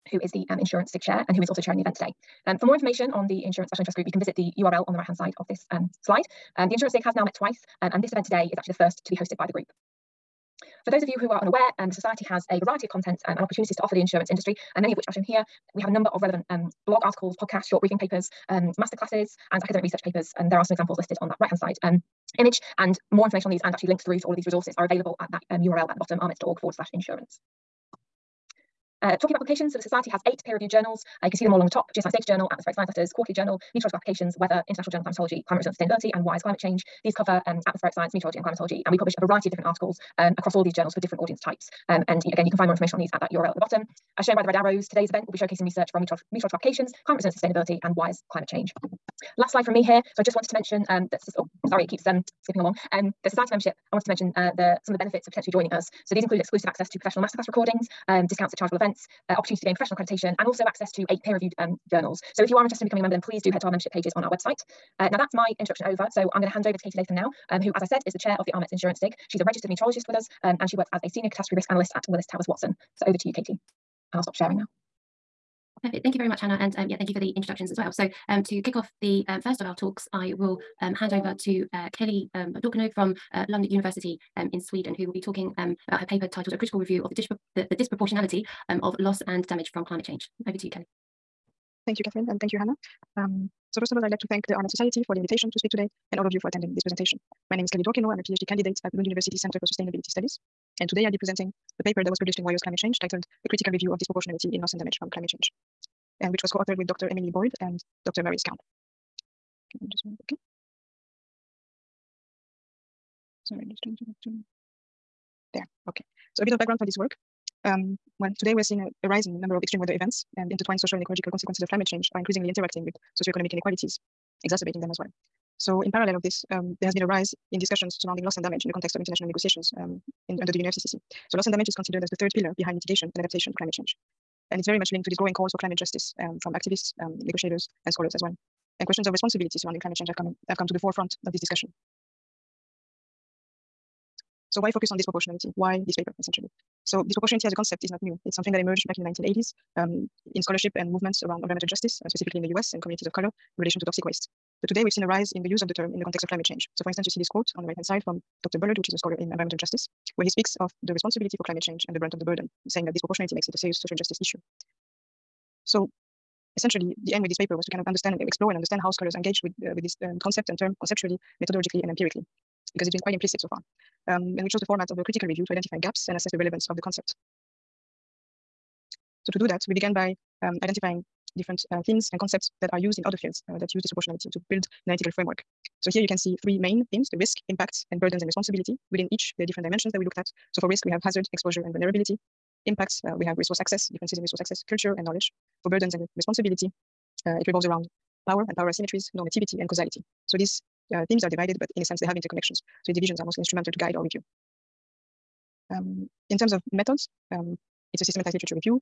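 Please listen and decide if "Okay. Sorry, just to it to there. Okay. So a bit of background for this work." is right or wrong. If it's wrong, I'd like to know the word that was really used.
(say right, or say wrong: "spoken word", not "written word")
right.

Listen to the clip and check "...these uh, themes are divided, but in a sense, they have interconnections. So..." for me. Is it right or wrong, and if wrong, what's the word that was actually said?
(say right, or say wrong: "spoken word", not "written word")
right.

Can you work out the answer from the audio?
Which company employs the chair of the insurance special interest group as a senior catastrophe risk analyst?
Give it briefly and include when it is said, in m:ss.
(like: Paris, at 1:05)
Willis Towers Watson, at 1:12.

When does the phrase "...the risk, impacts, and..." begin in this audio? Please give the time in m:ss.
3:07.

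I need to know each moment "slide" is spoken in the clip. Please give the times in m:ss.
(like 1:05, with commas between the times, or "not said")
0:06, 0:49.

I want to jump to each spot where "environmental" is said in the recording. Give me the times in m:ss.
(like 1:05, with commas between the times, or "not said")
2:31, 2:39.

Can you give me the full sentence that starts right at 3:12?
Impacts, uh, we have resource access, differences in resource access, culture, and knowledge.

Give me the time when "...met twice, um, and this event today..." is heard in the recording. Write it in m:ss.
0:07.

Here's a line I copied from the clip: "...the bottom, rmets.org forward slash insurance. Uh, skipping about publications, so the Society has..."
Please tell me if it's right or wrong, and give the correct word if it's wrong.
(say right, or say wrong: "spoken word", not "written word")
wrong: "talking", not "skipping".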